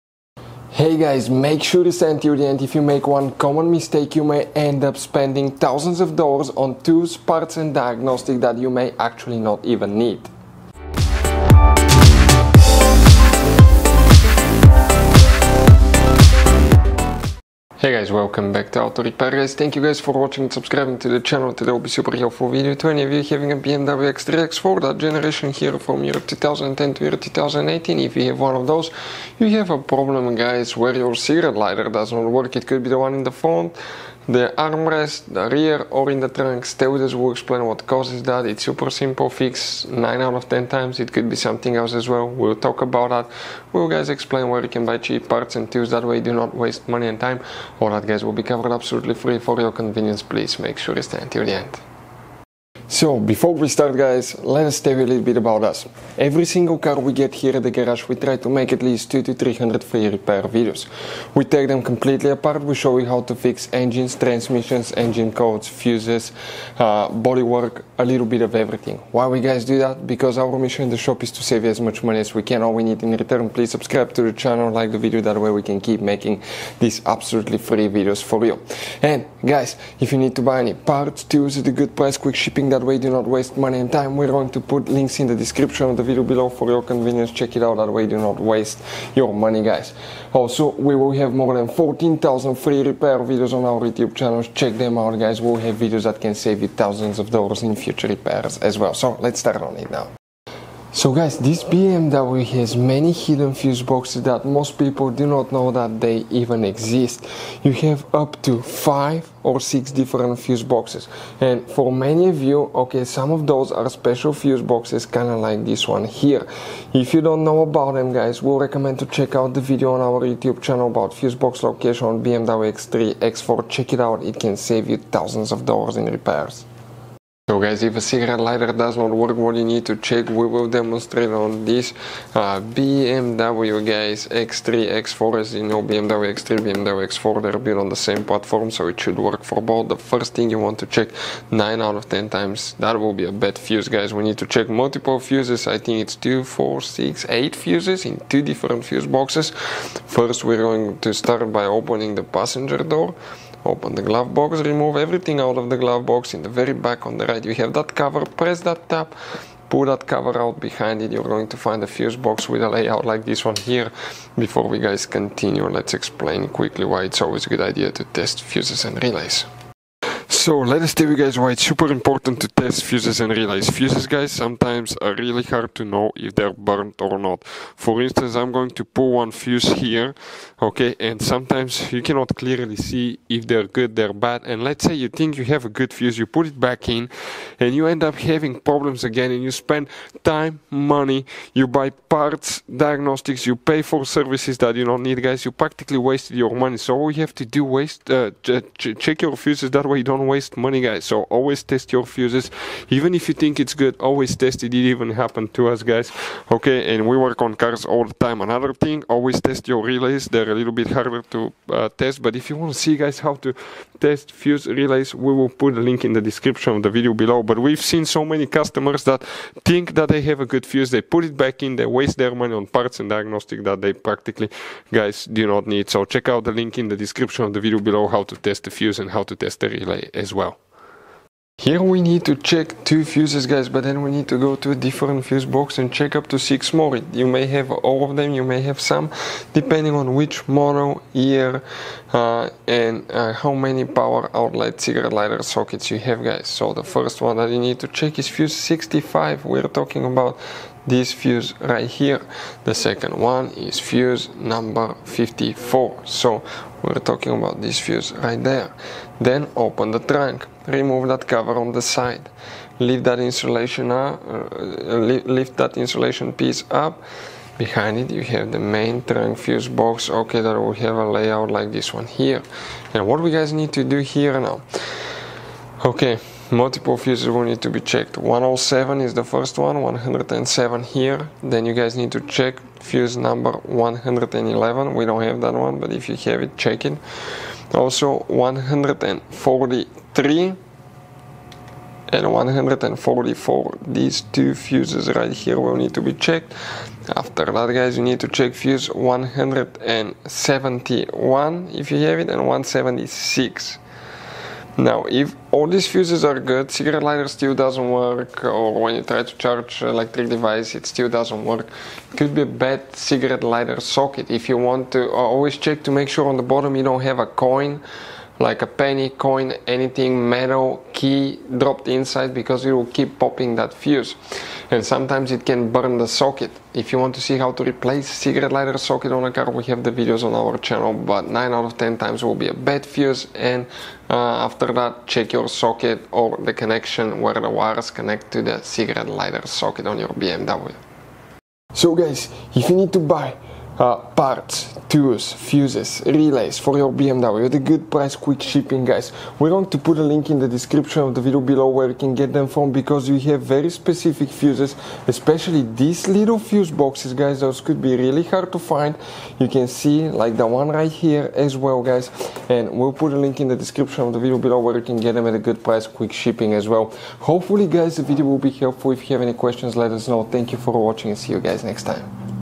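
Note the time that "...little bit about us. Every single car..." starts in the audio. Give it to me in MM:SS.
00:55.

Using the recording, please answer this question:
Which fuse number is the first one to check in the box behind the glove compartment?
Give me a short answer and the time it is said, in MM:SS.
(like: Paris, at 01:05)
65, at 04:08.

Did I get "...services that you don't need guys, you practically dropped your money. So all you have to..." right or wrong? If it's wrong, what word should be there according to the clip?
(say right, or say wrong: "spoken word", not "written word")
wrong: "wasted", not "dropped".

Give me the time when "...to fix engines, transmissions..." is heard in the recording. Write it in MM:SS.
01:03.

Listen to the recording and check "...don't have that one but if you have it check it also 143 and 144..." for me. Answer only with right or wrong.
right.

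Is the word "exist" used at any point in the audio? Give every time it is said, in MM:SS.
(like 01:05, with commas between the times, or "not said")
01:46.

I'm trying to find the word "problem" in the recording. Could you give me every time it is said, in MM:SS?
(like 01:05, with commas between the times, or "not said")
00:29, 03:08.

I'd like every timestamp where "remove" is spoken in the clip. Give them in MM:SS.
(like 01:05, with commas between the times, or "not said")
02:34, 04:20.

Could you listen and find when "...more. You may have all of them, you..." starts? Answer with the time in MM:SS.
03:56.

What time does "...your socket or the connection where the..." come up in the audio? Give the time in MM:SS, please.
05:35.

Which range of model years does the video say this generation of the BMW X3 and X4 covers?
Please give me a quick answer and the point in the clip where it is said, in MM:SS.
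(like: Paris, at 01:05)
2010 to 2018, at 00:26.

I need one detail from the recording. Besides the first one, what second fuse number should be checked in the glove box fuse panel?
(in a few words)
54.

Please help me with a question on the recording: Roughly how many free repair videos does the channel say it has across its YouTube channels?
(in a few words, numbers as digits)
14,000.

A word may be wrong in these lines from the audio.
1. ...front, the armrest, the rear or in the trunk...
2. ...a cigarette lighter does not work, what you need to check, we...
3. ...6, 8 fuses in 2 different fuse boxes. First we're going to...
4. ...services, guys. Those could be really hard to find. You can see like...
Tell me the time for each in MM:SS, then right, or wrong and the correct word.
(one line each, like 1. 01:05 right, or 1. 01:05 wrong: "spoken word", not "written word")
1. 00:33 right
2. 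02:07 right
3. 02:26 right
4. 05:56 wrong: "boxes", not "services".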